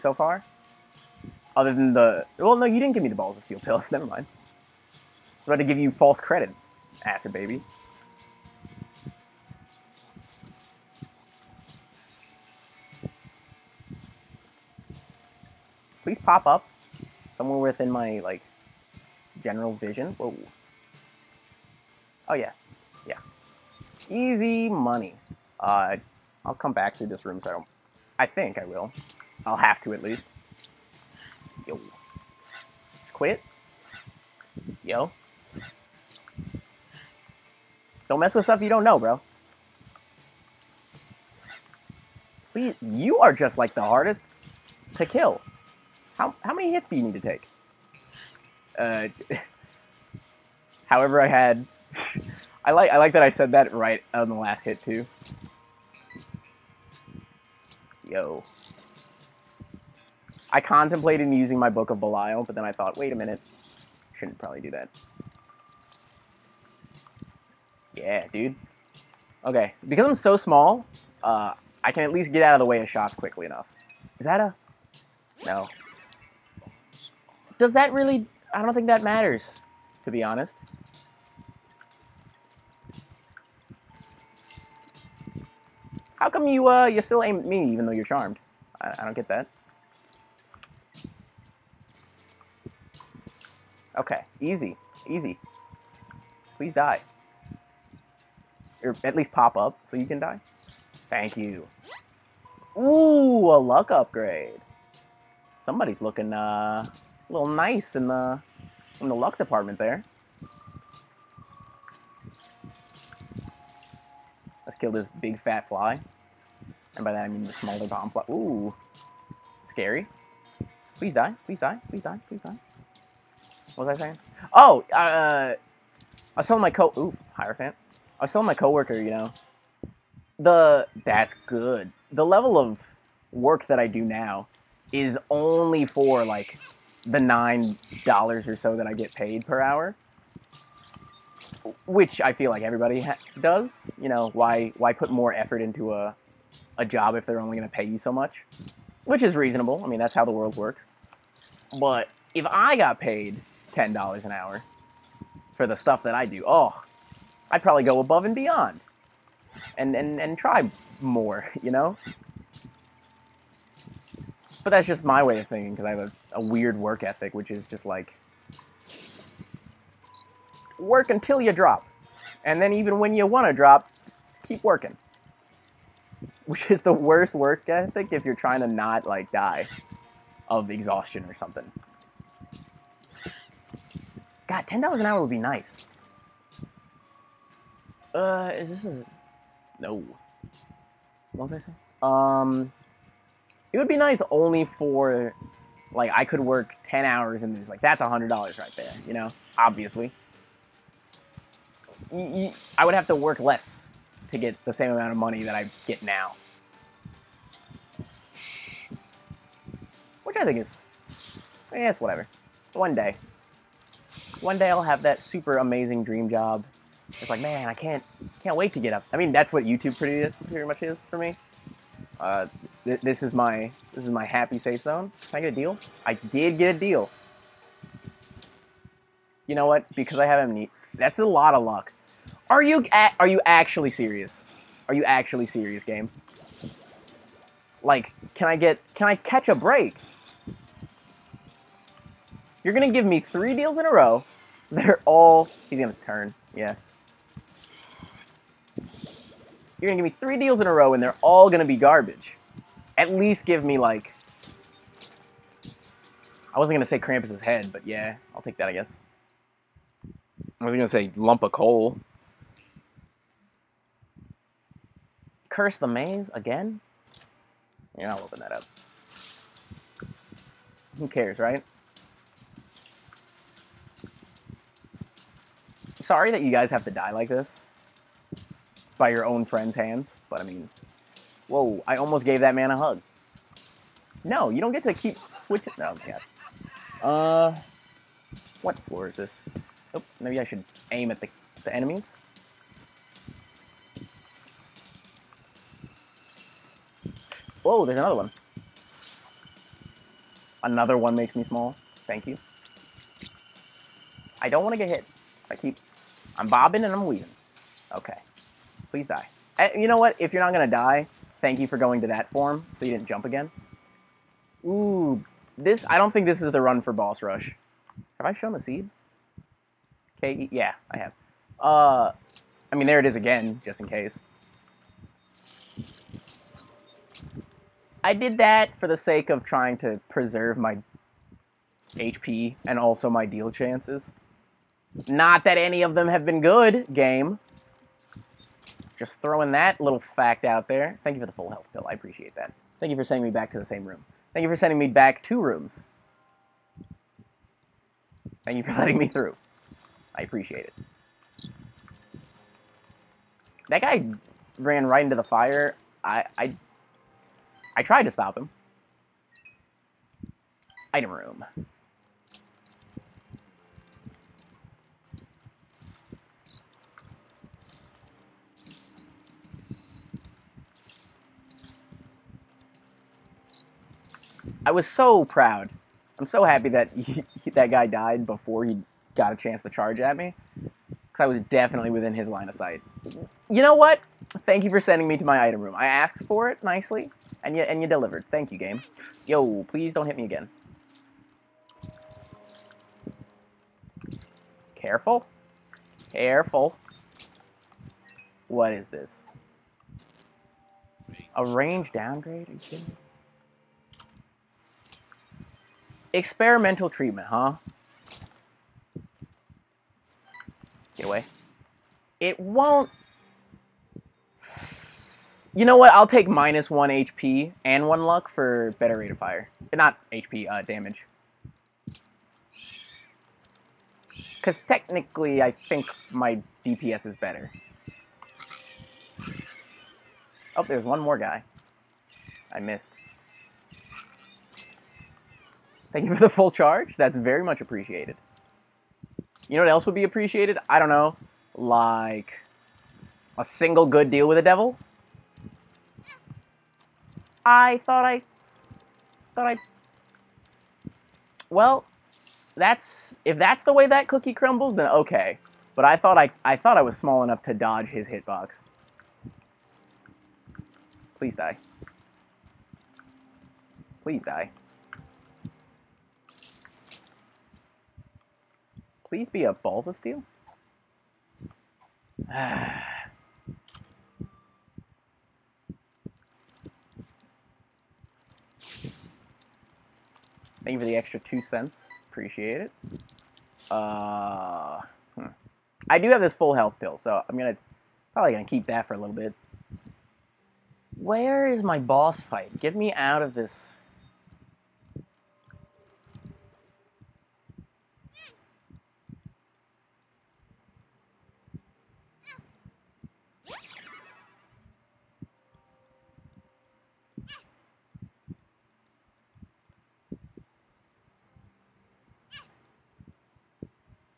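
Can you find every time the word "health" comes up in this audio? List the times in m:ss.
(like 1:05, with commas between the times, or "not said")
5:41, 8:06.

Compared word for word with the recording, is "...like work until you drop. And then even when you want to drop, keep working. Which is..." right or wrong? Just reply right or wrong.
right.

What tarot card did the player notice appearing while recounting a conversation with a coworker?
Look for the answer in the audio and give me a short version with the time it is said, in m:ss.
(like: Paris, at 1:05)
Hierophant, at 2:07.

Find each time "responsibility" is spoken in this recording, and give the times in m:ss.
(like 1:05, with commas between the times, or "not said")
not said.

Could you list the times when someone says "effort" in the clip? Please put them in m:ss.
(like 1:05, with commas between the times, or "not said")
2:25.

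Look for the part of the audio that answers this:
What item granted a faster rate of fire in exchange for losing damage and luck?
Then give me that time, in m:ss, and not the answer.
6:46.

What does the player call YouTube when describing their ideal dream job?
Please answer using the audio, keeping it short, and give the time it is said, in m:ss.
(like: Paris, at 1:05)
happy safe zone, at 3:44.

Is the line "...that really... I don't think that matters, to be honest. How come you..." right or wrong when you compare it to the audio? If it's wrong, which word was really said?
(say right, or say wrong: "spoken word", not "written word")
right.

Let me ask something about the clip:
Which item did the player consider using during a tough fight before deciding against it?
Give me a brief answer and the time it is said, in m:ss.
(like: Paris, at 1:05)
Book of Belial, at 1:01.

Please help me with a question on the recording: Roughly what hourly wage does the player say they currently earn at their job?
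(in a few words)
$9.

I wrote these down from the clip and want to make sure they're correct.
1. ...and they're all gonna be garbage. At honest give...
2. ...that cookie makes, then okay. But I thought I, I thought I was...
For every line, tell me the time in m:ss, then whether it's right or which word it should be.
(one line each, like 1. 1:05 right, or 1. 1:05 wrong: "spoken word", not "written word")
1. 4:10 wrong: "least", not "honest"
2. 7:33 wrong: "crumbles", not "makes".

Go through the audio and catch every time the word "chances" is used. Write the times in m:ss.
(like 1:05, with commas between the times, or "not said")
5:33, 6:19.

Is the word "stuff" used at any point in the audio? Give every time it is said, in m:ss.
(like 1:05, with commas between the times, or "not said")
0:38, 2:35.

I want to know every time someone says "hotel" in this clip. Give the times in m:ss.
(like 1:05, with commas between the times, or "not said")
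not said.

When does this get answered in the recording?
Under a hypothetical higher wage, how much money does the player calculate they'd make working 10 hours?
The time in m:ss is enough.
3:17.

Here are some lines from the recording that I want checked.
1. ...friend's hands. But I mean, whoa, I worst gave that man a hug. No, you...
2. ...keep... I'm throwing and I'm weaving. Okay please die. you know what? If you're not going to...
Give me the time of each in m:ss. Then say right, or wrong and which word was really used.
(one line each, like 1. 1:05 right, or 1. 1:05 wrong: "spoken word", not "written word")
1. 4:39 wrong: "almost", not "worst"
2. 5:05 wrong: "bobbing", not "throwing".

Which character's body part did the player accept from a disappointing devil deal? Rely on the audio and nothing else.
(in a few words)
Krampus's head.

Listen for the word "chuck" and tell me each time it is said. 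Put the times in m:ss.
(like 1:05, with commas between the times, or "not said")
not said.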